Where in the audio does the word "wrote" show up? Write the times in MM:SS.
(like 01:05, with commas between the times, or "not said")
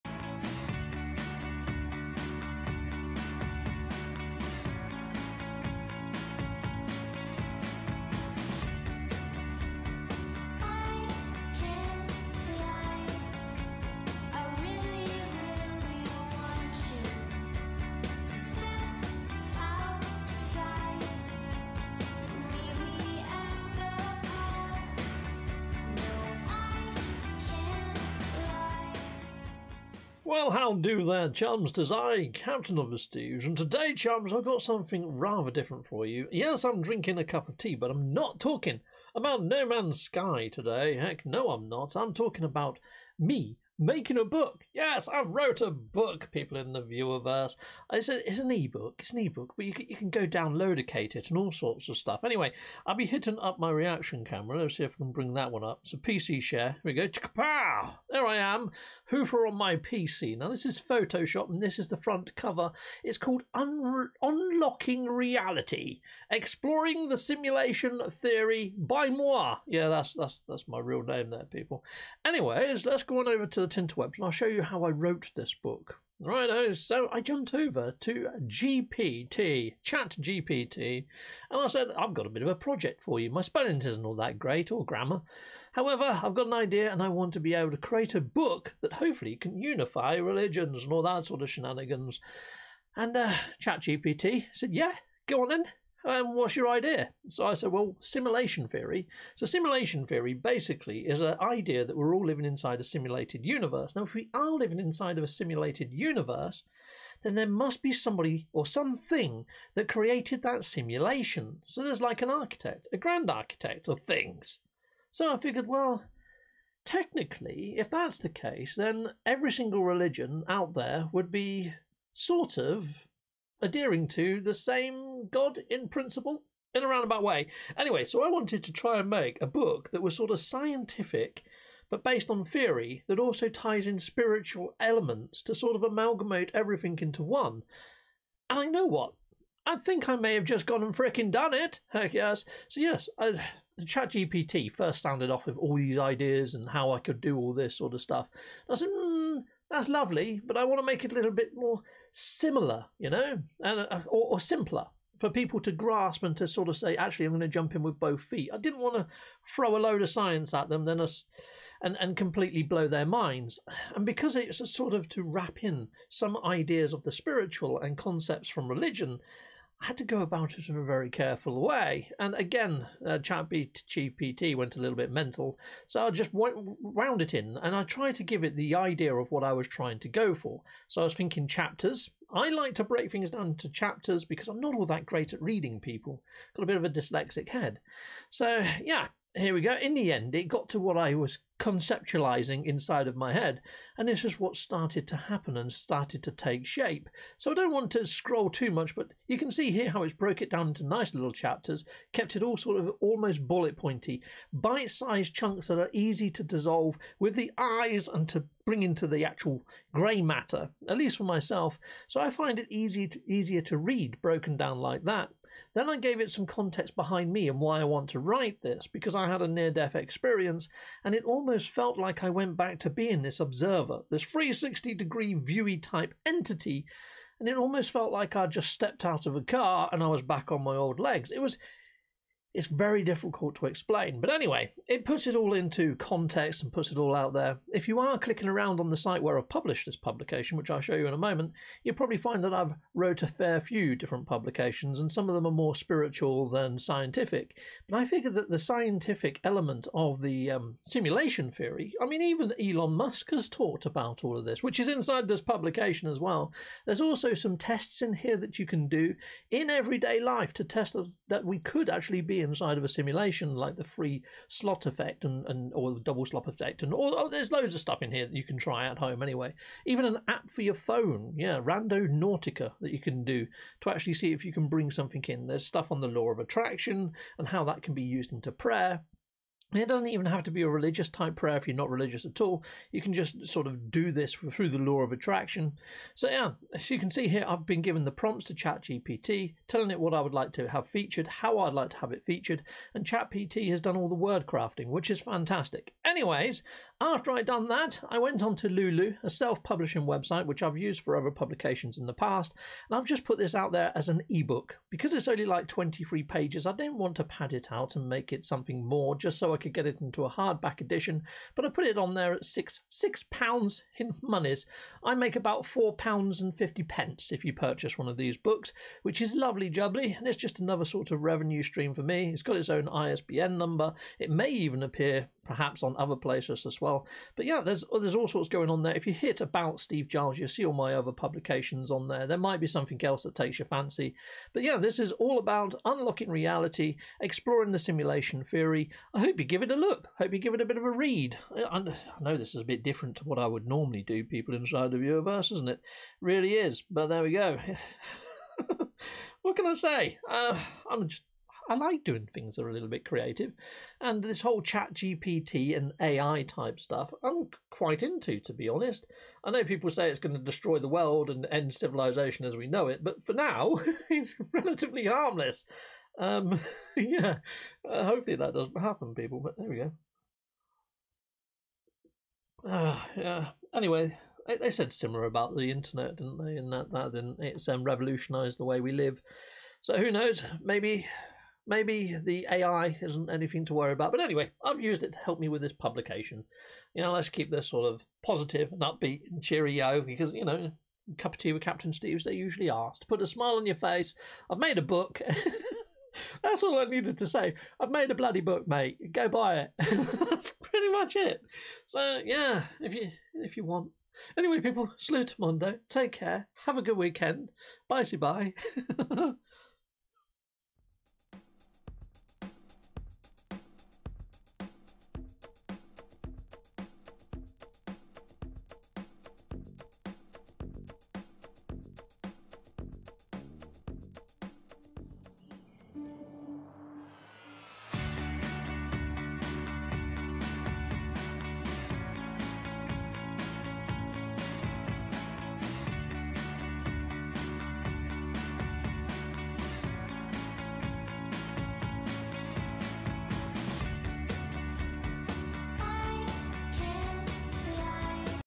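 00:45, 01:14, 04:02.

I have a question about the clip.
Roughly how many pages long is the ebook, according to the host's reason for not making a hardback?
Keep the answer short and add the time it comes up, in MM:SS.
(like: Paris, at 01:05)
23, at 05:05.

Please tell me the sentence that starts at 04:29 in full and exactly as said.
Even an app for your phone, yeah, Randonautica that you can do to actually see if you can bring something in.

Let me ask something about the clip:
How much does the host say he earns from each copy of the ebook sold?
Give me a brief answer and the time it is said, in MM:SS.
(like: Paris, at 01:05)
£4.50, at 05:15.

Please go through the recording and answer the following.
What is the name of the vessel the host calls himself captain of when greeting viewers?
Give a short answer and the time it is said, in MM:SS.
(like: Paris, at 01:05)
Prestige, at 00:32.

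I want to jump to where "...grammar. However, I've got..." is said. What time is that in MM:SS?
01:24.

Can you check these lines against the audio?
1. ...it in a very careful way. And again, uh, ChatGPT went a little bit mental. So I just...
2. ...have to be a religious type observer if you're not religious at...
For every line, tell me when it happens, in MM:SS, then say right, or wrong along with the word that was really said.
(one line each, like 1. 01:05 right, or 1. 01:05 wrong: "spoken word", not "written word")
1. 02:50 right
2. 04:40 wrong: "prayer", not "observer".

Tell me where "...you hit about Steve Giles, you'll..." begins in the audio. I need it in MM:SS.
05:29.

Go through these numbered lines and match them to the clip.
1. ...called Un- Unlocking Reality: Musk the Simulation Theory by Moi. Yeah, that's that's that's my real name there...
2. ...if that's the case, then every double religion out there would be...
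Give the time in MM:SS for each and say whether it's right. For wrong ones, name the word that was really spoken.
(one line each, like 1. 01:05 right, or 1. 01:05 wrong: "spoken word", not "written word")
1. 01:03 wrong: "Exploring", not "Musk"
2. 01:57 wrong: "single", not "double".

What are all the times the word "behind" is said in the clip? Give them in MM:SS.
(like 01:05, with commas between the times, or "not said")
03:36.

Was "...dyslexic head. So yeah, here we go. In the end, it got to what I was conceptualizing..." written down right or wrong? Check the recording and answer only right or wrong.
right.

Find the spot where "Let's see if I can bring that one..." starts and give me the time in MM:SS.
00:54.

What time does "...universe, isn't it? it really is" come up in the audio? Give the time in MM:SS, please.
05:44.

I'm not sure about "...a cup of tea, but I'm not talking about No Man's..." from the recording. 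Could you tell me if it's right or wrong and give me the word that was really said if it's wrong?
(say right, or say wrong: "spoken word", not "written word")
right.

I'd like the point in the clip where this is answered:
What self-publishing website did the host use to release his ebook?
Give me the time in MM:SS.
04:58.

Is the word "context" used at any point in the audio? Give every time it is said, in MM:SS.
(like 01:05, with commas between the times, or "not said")
03:36, 03:55.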